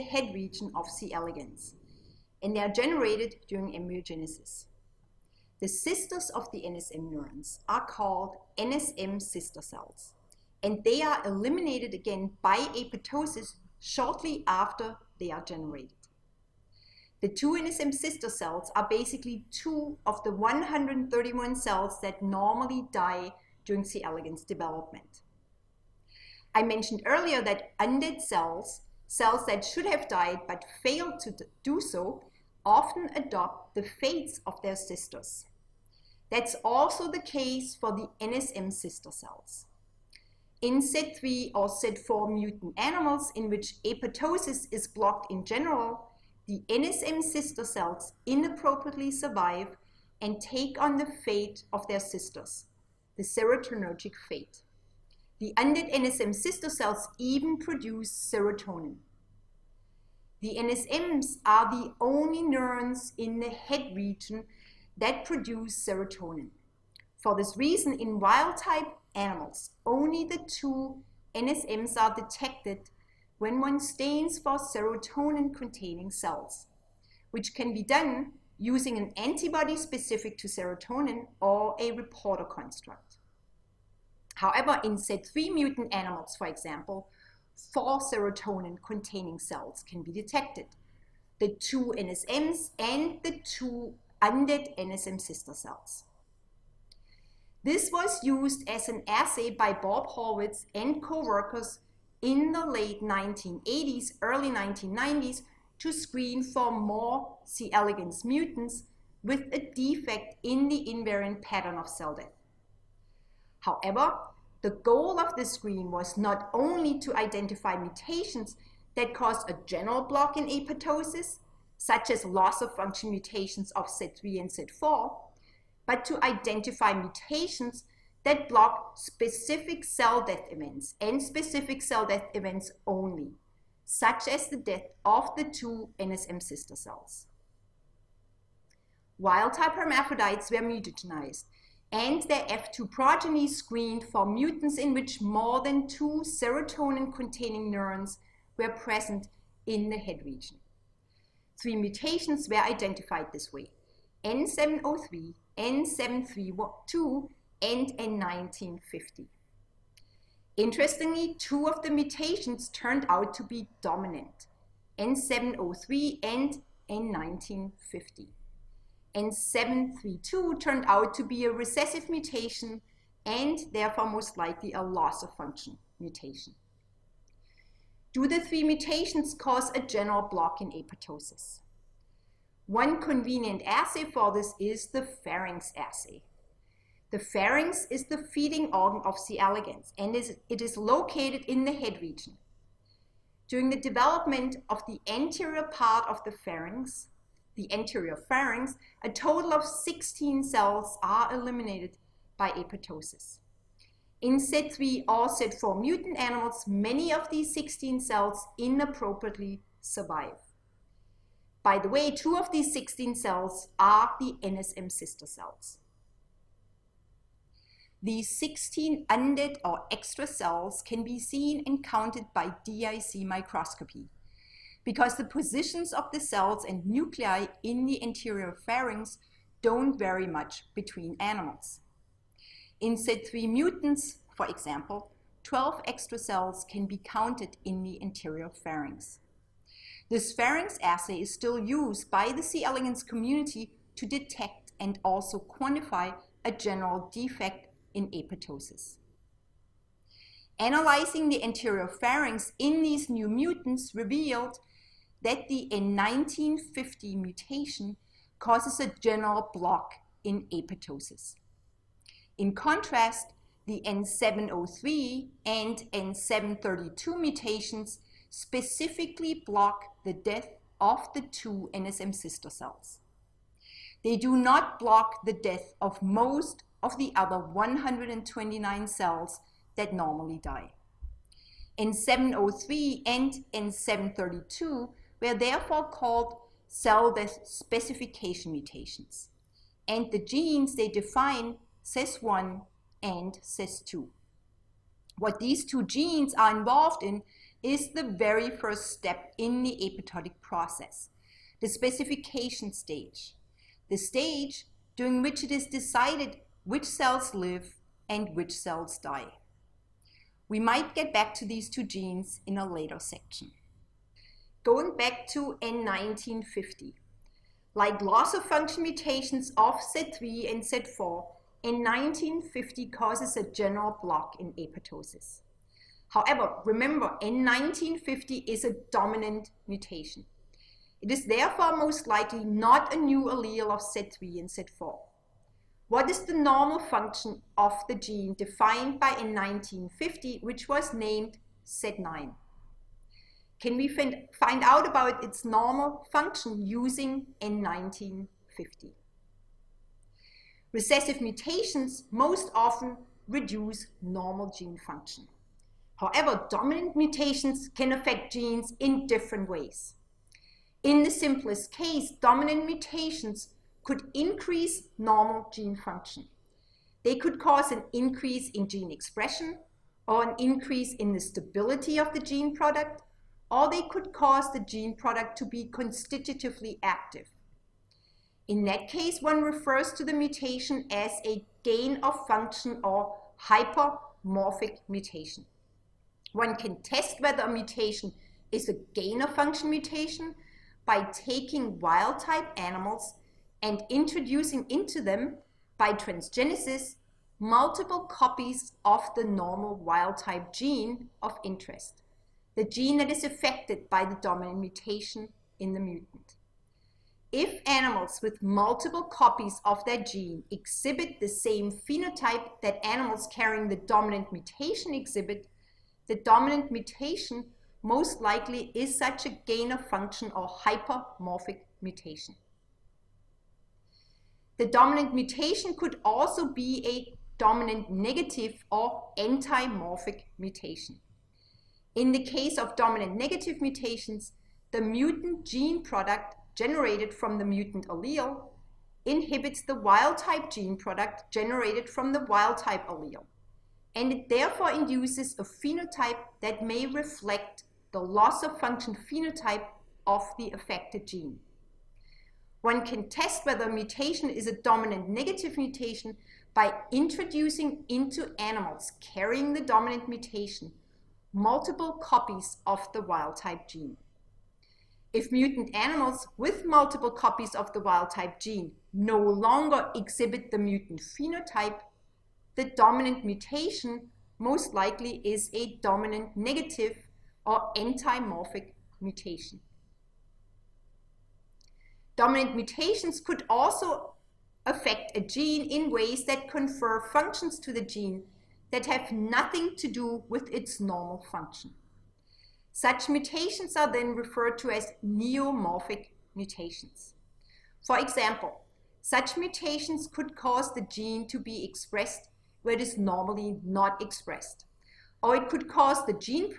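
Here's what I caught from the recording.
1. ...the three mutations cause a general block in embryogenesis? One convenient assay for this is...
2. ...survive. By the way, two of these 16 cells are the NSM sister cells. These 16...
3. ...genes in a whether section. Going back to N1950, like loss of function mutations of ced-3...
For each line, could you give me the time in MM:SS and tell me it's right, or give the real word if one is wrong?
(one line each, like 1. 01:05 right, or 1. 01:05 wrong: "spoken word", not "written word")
1. 02:58 wrong: "apoptosis", not "embryogenesis"
2. 03:29 right
3. 05:11 wrong: "later", not "whether".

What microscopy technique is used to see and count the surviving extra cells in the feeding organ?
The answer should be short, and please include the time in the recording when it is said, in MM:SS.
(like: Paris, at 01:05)
DIC microscopy, at 03:42.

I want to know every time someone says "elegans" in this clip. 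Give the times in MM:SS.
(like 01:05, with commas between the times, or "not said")
00:01, 00:24, 01:47, 03:09, 04:02.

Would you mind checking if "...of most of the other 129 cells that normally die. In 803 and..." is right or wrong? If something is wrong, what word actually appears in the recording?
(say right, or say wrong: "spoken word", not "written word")
wrong: "703", not "803".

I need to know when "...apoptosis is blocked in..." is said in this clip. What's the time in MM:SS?
00:43.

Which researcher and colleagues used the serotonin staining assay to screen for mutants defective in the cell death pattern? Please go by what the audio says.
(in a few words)
Bob Horvitz.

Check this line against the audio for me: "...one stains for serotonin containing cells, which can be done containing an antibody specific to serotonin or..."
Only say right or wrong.
wrong.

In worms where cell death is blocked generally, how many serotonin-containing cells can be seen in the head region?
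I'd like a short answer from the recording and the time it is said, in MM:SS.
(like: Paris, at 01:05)
4, at 01:27.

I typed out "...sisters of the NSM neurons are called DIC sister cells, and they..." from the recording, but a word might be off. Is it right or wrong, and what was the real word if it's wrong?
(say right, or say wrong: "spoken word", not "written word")
wrong: "NSM", not "DIC".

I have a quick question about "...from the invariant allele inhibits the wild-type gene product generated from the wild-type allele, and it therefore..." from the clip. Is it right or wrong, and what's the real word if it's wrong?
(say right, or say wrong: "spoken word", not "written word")
wrong: "mutant", not "invariant".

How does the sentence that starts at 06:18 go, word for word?
In that case, one refers to the mutation as a gain of function or hypermorphic mutation.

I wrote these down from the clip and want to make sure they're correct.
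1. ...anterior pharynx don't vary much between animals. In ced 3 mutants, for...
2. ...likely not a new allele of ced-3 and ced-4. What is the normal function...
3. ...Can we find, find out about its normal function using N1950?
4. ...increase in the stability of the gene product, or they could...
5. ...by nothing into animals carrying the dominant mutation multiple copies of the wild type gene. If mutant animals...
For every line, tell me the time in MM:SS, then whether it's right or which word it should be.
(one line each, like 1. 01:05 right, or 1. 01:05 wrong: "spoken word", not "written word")
1. 03:48 right
2. 05:32 right
3. 05:43 right
4. 06:10 right
5. 07:36 wrong: "introducing", not "nothing".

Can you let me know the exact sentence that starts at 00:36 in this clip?
That's also the case for the NSM sister cells.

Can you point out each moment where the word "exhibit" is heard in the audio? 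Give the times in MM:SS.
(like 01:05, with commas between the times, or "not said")
06:50, 06:54, 07:49.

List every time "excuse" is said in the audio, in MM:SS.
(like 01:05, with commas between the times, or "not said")
not said.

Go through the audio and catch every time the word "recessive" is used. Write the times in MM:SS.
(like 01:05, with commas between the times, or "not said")
02:51, 05:50.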